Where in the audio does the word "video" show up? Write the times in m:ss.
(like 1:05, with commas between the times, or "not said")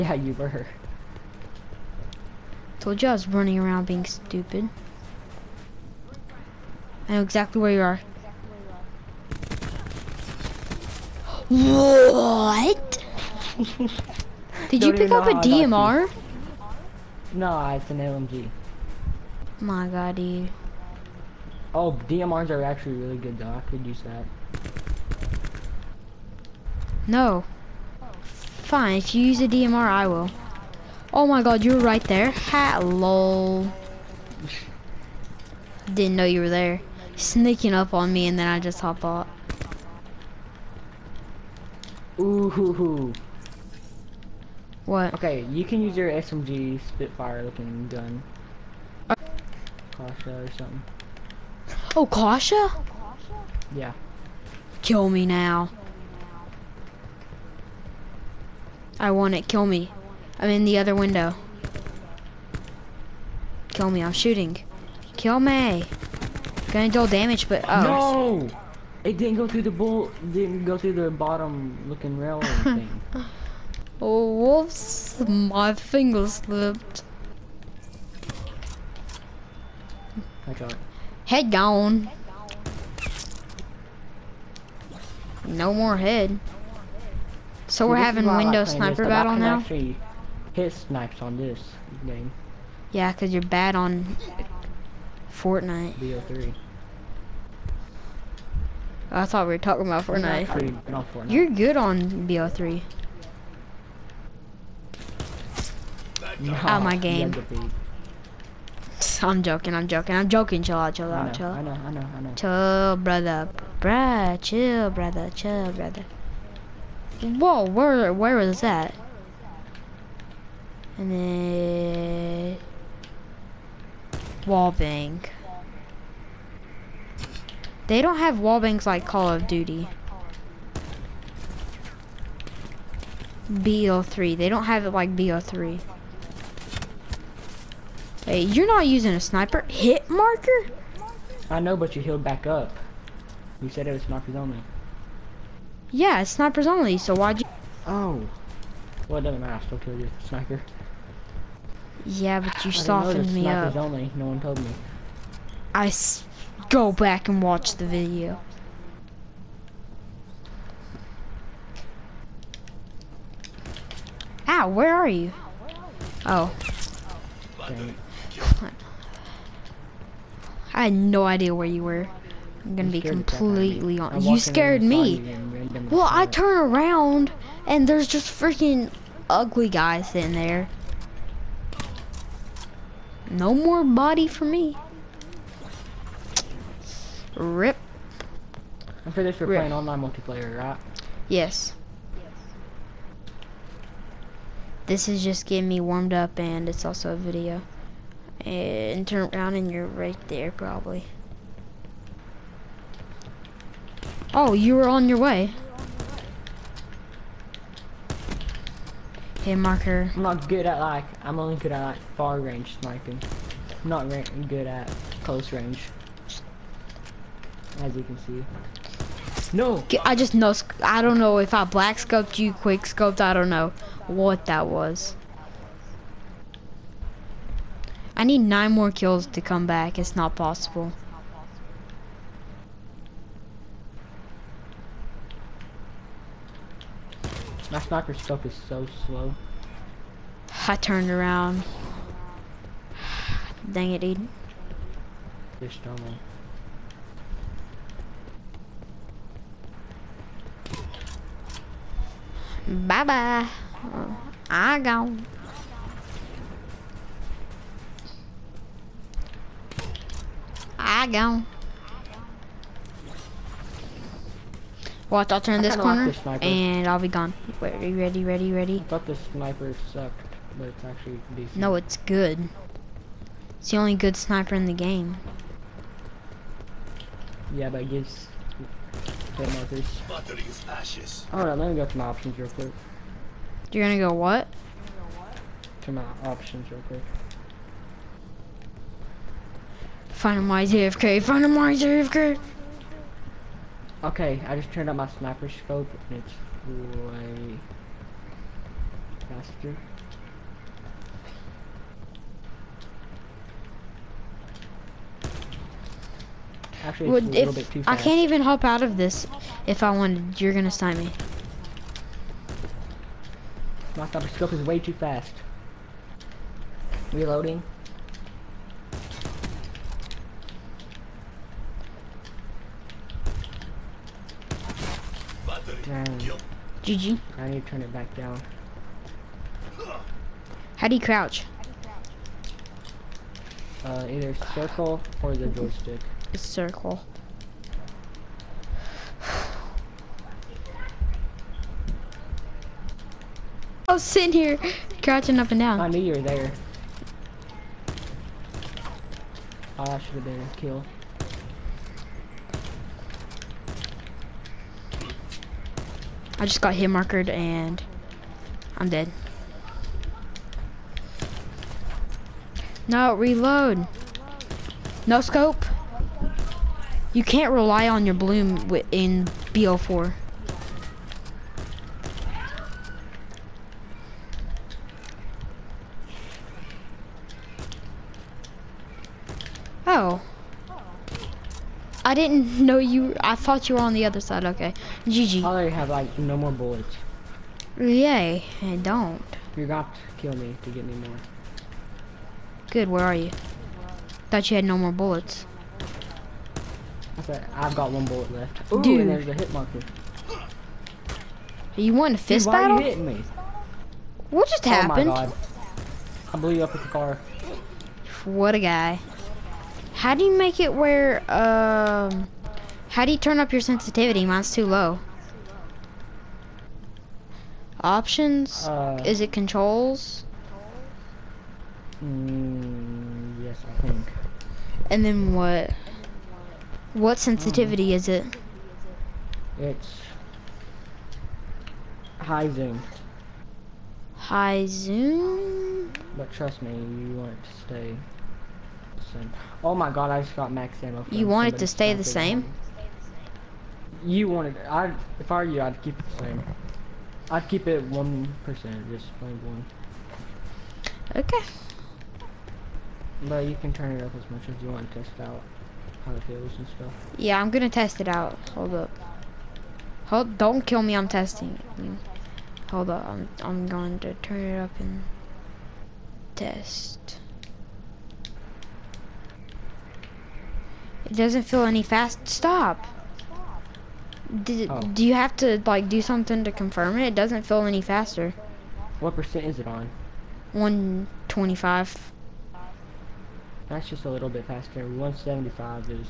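2:37, 3:17.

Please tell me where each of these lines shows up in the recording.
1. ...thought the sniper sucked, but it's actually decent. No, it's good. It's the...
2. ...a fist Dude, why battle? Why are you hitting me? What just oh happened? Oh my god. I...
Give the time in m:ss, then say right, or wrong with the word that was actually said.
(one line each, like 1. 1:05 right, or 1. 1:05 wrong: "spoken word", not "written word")
1. 4:28 right
2. 6:42 right.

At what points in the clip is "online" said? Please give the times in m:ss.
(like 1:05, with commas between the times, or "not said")
3:09.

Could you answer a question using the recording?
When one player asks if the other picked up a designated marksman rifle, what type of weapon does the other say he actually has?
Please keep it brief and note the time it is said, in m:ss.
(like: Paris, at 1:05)
LMG, at 0:17.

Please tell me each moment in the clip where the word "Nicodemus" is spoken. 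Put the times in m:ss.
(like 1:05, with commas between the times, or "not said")
not said.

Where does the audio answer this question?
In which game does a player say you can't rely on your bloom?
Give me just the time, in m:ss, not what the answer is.
6:09.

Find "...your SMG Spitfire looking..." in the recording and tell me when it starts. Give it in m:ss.
0:45.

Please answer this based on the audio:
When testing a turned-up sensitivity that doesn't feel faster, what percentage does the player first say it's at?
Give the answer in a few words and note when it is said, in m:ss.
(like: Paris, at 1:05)
125, at 8:00.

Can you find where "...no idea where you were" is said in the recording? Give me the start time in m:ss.
2:50.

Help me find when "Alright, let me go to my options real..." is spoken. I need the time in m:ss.
4:41.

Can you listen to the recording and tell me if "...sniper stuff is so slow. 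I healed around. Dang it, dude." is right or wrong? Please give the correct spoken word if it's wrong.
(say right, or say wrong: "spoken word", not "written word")
wrong: "turned", not "healed".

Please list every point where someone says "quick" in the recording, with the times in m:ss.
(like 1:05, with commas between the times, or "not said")
3:42, 4:42, 4:46.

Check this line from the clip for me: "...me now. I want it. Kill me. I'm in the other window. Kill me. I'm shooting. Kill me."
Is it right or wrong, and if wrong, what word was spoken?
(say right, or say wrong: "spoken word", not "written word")
right.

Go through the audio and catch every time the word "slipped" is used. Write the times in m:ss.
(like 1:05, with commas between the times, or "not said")
1:16.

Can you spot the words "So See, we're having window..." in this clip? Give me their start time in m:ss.
1:27.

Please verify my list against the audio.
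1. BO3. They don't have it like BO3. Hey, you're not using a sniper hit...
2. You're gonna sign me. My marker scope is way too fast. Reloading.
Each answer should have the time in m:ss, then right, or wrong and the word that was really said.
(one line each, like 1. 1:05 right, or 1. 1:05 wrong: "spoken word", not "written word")
1. 2:13 right
2. 5:10 wrong: "thumper", not "marker".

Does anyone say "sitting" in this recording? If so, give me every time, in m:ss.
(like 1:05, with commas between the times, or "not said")
3:00, 5:44.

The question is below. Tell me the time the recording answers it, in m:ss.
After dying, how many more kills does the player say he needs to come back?
3:48.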